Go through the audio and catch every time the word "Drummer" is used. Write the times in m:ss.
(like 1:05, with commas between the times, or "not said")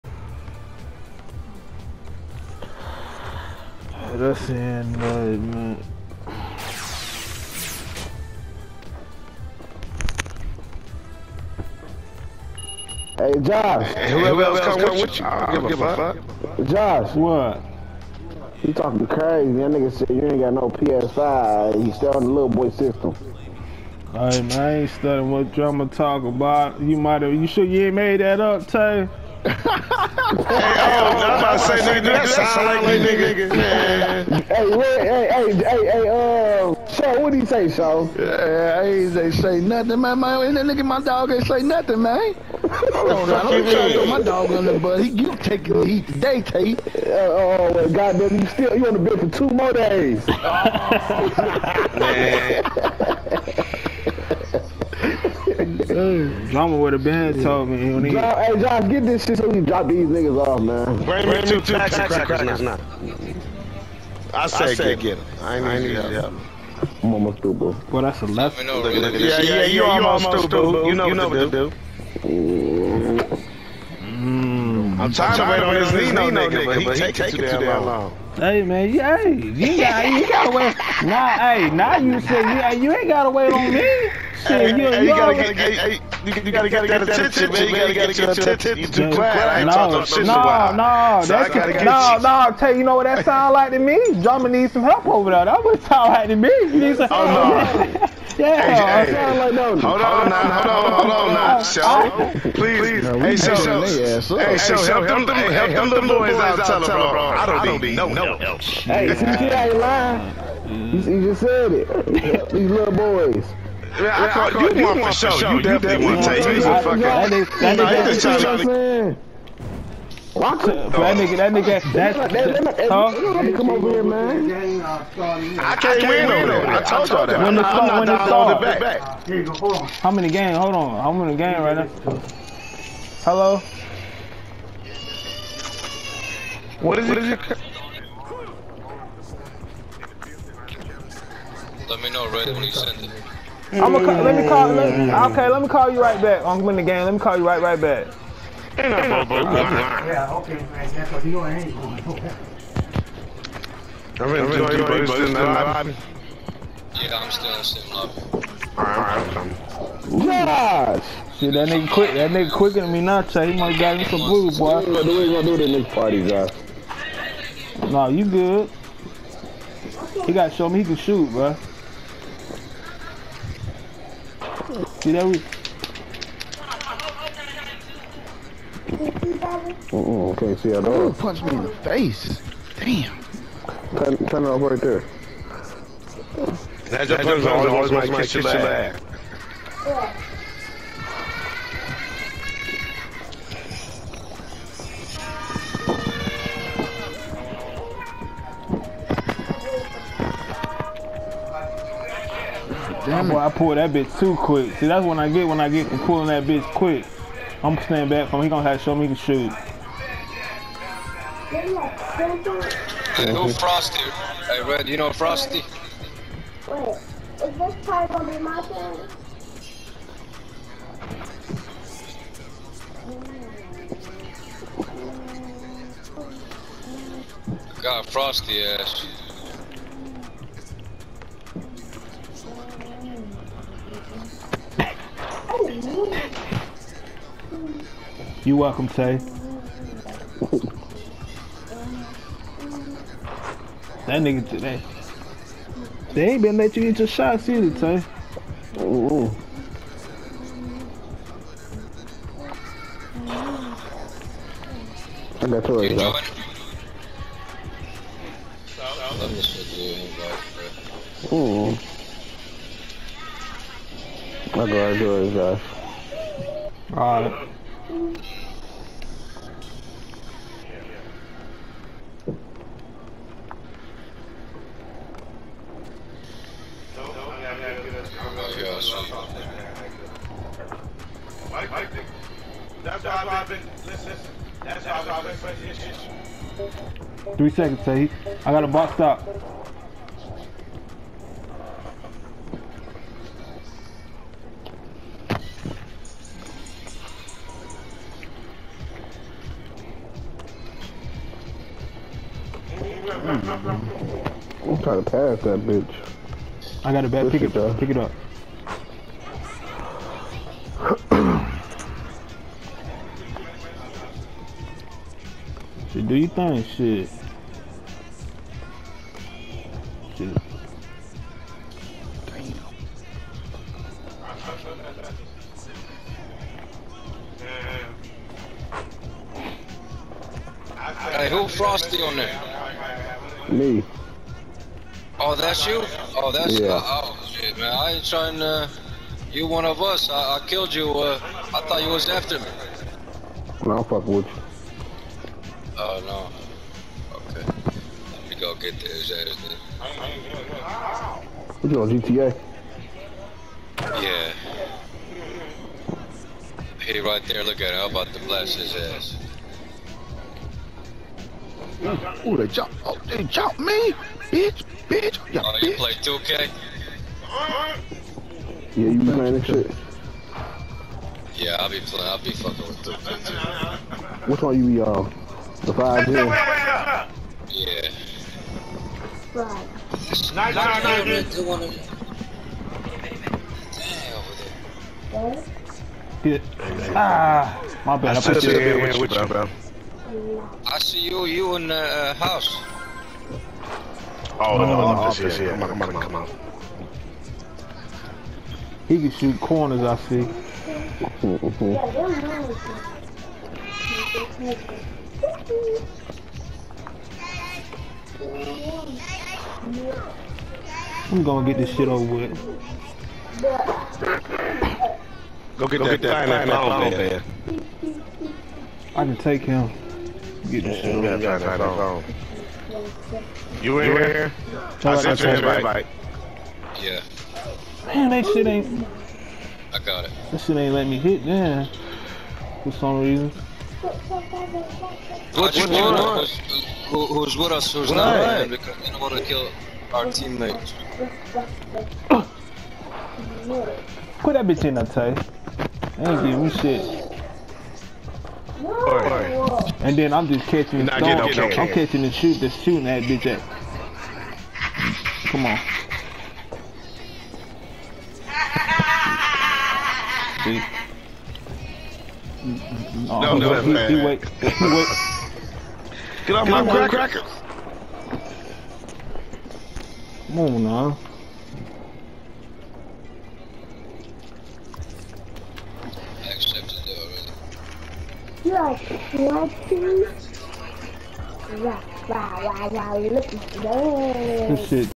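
1:34.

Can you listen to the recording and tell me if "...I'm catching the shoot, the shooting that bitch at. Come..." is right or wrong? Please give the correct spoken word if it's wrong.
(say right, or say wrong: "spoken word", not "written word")
right.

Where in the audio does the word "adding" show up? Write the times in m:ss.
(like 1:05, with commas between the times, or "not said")
not said.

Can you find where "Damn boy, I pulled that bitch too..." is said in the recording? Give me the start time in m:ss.
3:23.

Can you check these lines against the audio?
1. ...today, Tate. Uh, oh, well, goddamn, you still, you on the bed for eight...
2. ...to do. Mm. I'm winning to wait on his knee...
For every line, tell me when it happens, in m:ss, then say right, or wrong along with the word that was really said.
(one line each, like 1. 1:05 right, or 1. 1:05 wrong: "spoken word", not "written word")
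1. 0:46 wrong: "two", not "eight"
2. 1:11 wrong: "trying", not "winning".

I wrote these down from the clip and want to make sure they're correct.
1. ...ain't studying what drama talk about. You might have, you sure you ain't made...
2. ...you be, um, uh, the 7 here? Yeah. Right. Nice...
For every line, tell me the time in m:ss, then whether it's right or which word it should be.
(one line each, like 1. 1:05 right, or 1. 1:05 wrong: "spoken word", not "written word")
1. 0:24 right
2. 6:14 wrong: "5", not "7".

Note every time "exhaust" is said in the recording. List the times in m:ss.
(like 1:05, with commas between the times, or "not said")
not said.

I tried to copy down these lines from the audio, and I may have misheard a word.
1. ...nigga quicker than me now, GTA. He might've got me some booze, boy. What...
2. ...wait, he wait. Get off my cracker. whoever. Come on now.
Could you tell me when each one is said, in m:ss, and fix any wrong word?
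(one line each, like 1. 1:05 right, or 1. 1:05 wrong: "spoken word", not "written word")
1. 2:42 wrong: "Chad", not "GTA"
2. 7:44 wrong: "cracker", not "whoever".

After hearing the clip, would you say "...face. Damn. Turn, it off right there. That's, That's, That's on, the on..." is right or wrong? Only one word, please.
right.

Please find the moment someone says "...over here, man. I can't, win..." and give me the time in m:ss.
2:03.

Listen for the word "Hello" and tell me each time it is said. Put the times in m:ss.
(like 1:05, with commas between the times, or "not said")
2:13.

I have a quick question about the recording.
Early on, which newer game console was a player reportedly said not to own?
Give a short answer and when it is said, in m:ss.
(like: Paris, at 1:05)
PS5, at 0:20.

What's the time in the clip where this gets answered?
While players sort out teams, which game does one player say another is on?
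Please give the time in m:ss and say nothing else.
5:51.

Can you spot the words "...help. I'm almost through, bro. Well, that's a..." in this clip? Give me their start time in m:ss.
1:05.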